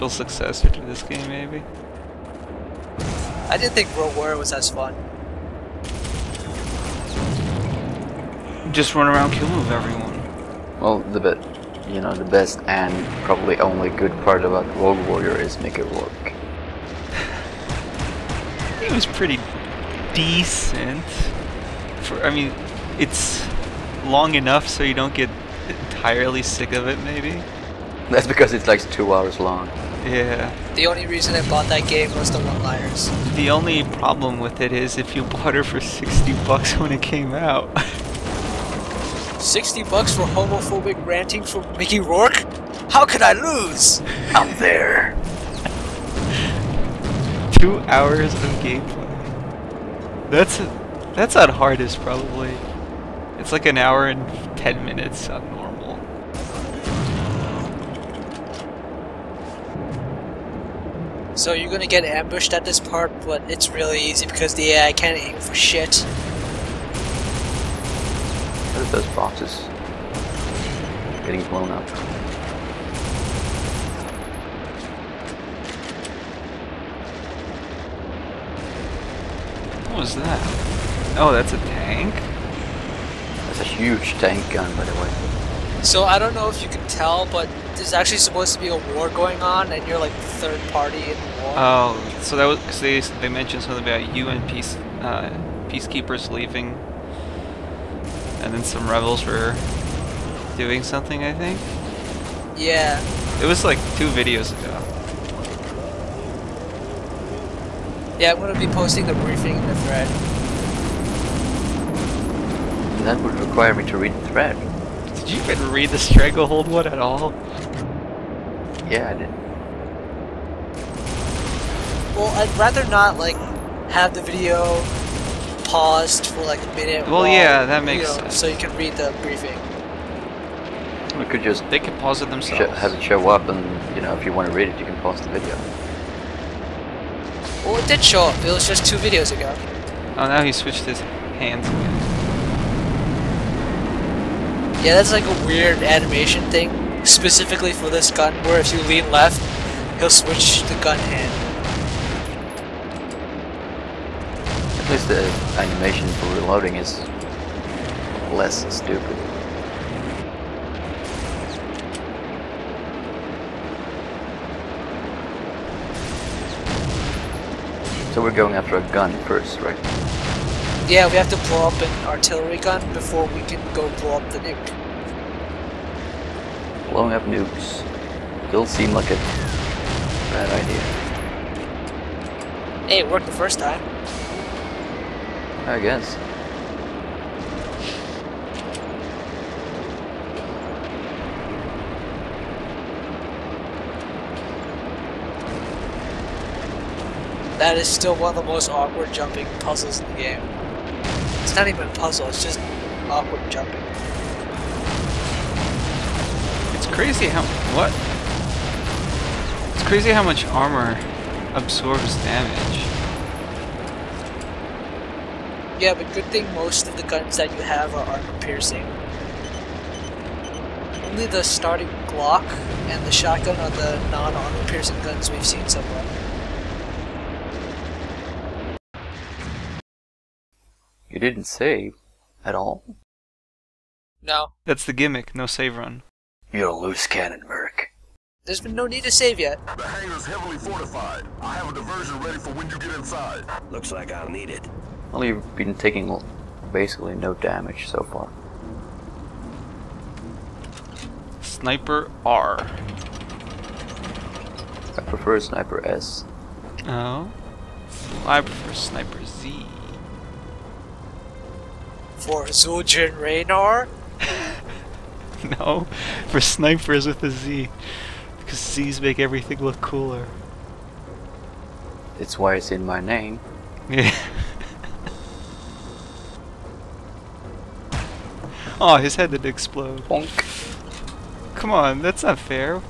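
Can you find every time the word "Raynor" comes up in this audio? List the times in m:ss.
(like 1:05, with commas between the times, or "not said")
4:23.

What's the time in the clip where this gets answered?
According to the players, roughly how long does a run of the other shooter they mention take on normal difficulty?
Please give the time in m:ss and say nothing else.
0:53.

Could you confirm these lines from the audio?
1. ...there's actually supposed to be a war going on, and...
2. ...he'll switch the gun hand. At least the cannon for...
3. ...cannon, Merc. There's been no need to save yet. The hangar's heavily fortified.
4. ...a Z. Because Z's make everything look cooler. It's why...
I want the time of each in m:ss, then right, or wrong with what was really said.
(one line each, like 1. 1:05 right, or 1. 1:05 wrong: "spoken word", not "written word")
1. 1:27 right
2. 2:29 wrong: "animation", not "cannon"
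3. 3:57 right
4. 4:27 right.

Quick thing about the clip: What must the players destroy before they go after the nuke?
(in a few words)
An artillery gun.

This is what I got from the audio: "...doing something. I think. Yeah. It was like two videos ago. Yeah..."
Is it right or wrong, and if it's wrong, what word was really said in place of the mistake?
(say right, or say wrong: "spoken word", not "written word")
right.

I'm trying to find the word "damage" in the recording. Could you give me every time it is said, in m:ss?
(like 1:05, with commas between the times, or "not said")
3:32, 4:07.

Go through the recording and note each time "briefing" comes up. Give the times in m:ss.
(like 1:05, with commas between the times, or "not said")
1:49, 2:09.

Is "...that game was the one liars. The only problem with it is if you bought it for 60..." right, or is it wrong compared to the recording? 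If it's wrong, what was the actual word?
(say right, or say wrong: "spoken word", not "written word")
right.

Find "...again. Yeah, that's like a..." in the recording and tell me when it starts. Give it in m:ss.
2:21.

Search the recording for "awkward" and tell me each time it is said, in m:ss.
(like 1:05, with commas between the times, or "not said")
3:18, 3:23.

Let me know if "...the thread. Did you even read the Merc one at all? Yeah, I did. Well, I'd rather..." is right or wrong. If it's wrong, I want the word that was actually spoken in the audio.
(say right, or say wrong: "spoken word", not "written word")
wrong: "Stranglehold", not "Merc".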